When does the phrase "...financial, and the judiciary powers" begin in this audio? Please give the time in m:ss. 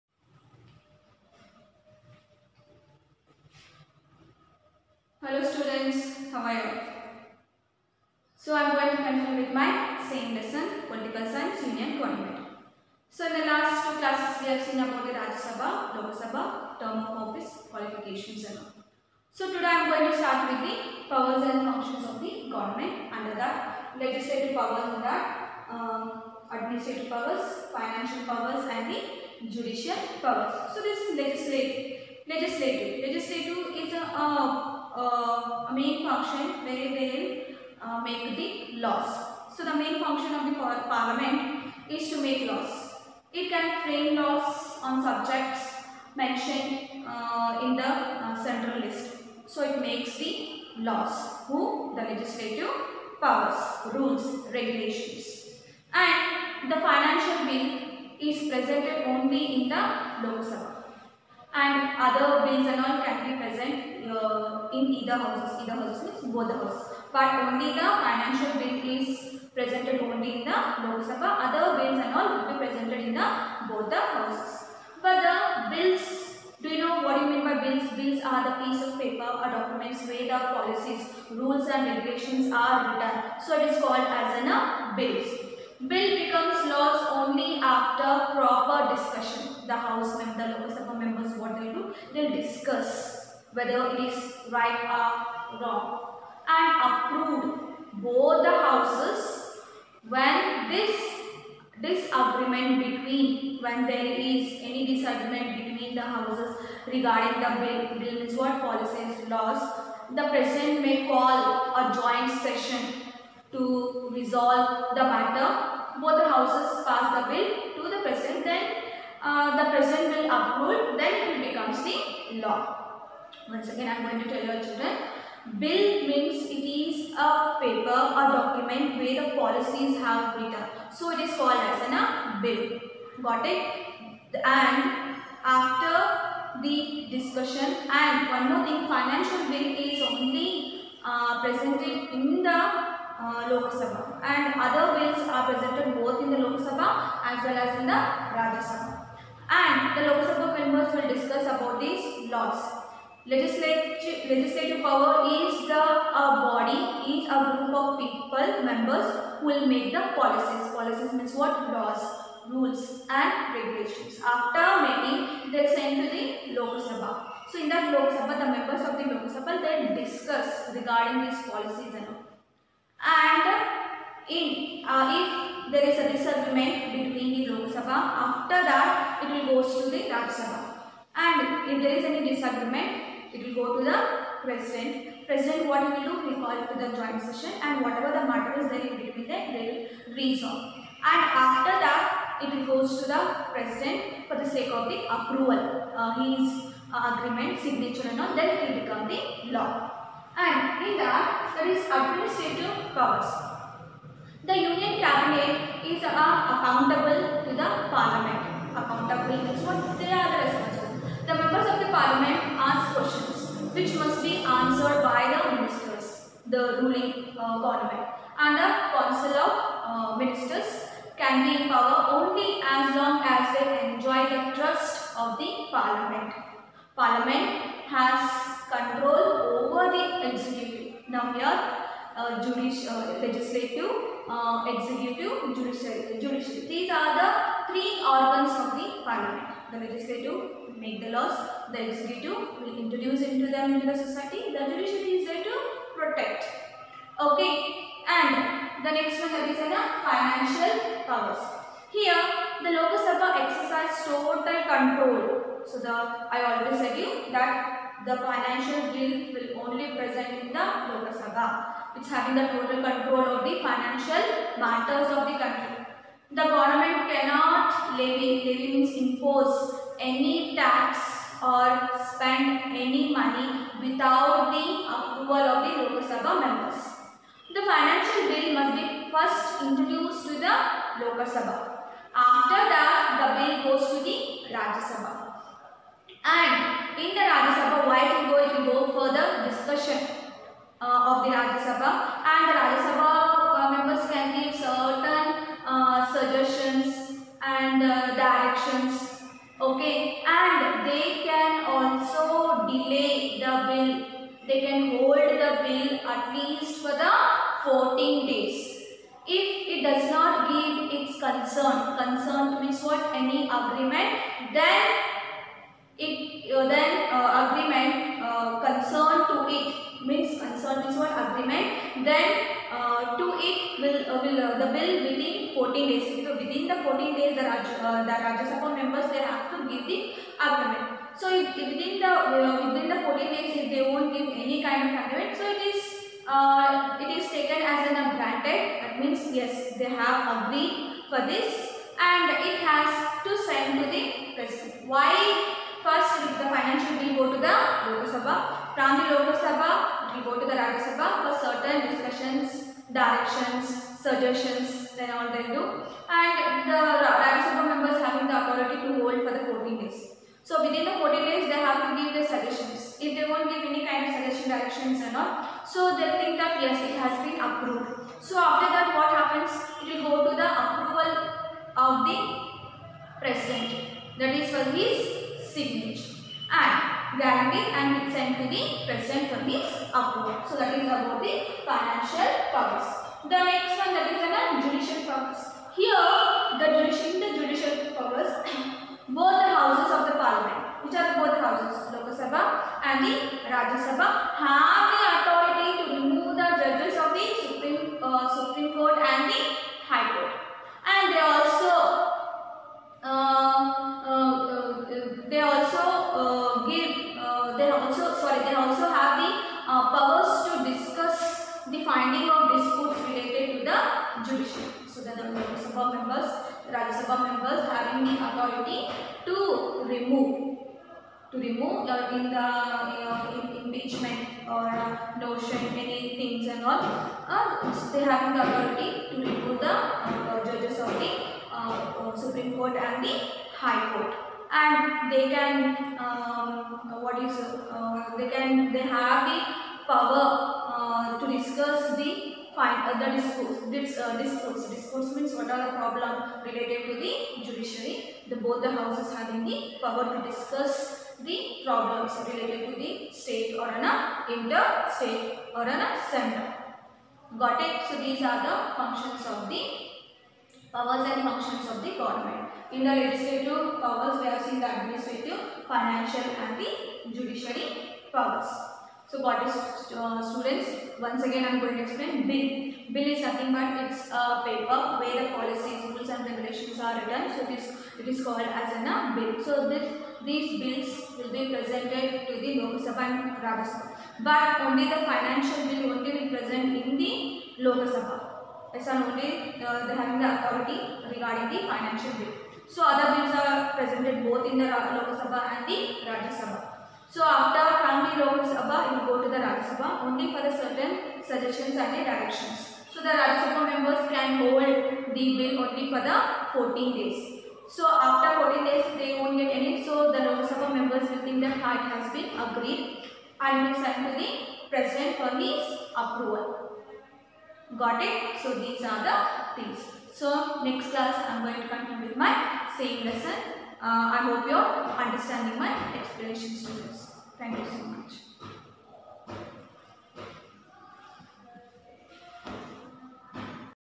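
7:45.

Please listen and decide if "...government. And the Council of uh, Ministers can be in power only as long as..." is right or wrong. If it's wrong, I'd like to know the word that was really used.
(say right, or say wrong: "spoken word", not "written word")
right.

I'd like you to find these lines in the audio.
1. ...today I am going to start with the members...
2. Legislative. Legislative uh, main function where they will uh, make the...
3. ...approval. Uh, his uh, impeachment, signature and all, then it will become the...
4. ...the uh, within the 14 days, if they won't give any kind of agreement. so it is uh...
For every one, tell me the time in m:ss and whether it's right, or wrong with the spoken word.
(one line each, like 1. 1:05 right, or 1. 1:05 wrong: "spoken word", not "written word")
1. 0:19 wrong: "powers", not "members"
2. 0:32 right
3. 3:15 wrong: "agreement", not "impeachment"
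4. 5:31 right.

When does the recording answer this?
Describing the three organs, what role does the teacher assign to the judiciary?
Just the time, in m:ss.
4:05.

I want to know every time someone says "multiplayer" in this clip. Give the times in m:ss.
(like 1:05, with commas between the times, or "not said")
not said.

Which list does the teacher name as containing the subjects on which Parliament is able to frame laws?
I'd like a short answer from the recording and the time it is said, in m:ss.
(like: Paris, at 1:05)
central list, at 0:48.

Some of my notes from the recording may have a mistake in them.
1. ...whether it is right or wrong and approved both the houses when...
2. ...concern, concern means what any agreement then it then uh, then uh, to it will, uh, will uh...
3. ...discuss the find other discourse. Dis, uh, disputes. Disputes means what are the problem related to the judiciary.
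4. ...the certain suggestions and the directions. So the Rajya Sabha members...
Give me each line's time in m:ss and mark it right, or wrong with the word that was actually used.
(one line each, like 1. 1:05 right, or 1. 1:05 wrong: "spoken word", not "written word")
1. 1:33 right
2. 5:11 right
3. 7:21 right
4. 8:20 right.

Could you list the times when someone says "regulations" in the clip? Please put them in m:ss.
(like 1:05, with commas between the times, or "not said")
0:54, 1:21, 2:43, 7:56.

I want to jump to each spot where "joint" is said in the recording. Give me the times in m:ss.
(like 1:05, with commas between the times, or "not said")
1:51, 3:06.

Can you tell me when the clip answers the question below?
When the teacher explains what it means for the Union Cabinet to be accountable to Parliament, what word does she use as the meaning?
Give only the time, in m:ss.
3:30.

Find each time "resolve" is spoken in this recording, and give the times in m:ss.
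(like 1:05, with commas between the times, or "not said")
1:54, 3:10.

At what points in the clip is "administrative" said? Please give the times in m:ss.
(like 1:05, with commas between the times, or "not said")
0:26, 3:21, 7:44.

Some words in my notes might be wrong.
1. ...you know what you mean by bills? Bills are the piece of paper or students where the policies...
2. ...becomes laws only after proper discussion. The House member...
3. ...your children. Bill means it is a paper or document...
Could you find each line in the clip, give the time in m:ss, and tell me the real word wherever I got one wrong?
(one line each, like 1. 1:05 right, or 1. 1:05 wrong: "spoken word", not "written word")
1. 1:16 wrong: "documents", not "students"
2. 1:26 right
3. 2:04 right.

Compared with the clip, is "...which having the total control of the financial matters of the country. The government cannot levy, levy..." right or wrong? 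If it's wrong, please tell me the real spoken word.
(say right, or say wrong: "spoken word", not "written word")
right.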